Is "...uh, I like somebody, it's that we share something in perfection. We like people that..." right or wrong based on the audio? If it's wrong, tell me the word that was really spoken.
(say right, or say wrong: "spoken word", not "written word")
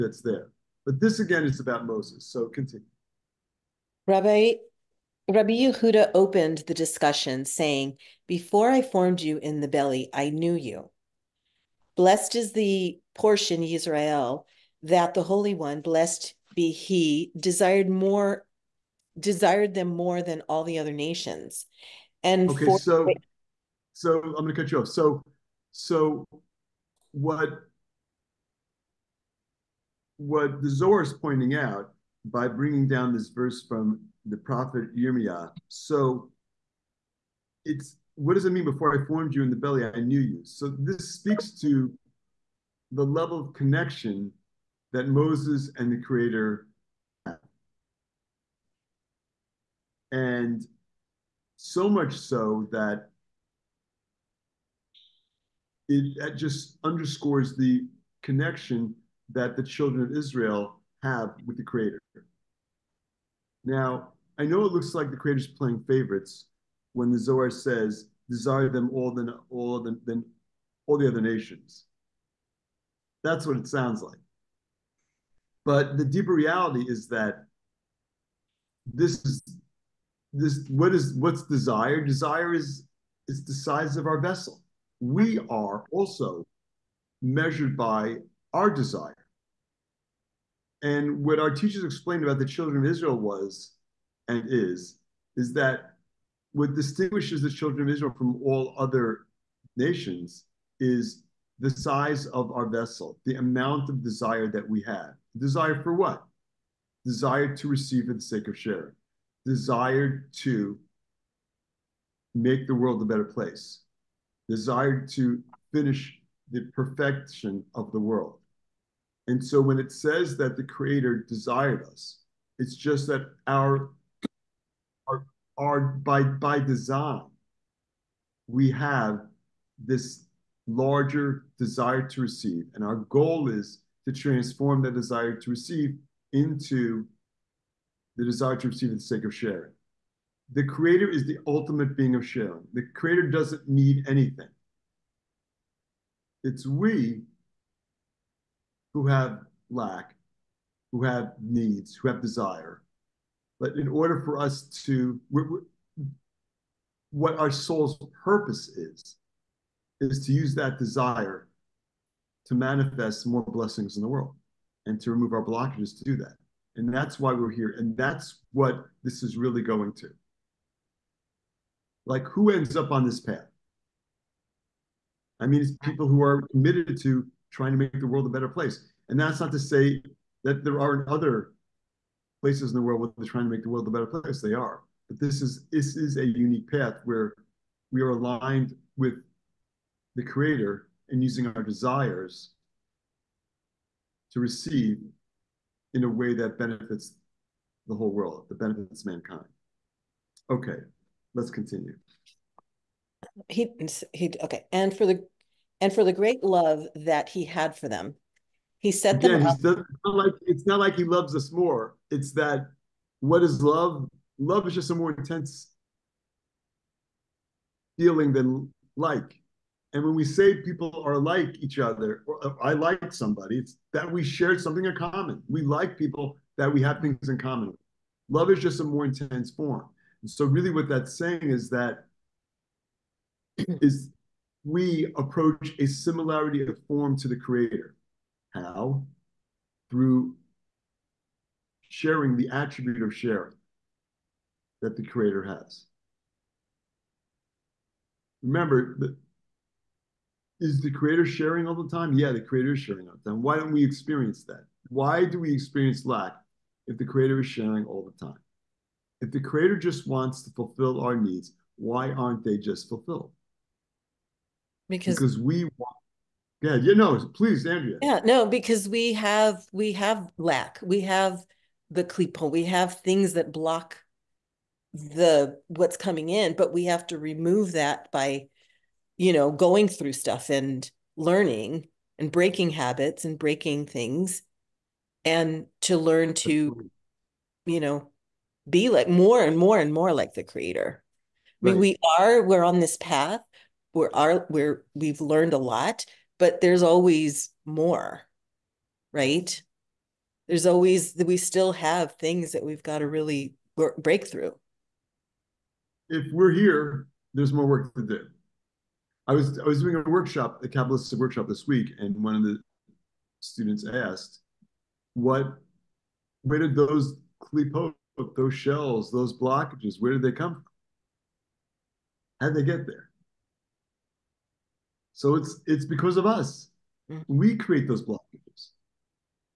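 wrong: "common", not "perfection".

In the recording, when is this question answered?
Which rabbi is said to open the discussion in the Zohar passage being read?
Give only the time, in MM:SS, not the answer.
00:05.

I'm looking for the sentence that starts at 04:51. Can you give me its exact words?
I mean, we are, we're on this path.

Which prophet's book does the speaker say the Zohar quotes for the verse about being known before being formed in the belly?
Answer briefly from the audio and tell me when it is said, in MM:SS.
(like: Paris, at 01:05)
Yirmiyah, at 00:34.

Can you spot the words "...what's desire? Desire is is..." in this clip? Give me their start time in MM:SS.
01:21.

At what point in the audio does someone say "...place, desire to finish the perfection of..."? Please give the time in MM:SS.
01:53.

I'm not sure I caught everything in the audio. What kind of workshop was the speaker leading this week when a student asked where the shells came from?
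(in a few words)
Kabbalistic workshop.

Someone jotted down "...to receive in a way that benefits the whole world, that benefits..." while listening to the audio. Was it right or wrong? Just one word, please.
right.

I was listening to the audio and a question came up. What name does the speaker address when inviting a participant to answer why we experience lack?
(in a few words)
Andrea.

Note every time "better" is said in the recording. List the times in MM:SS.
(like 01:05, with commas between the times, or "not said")
01:53, 02:58, 03:03.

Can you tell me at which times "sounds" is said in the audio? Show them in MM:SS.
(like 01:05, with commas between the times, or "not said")
01:13.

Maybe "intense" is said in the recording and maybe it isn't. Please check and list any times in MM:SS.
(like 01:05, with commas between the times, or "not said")
03:35, 03:49.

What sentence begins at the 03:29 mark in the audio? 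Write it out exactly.
Not like, it's not like he loves us more it's that what is love?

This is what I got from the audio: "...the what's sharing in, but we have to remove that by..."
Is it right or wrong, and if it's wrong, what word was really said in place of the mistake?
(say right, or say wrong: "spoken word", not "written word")
wrong: "coming", not "sharing".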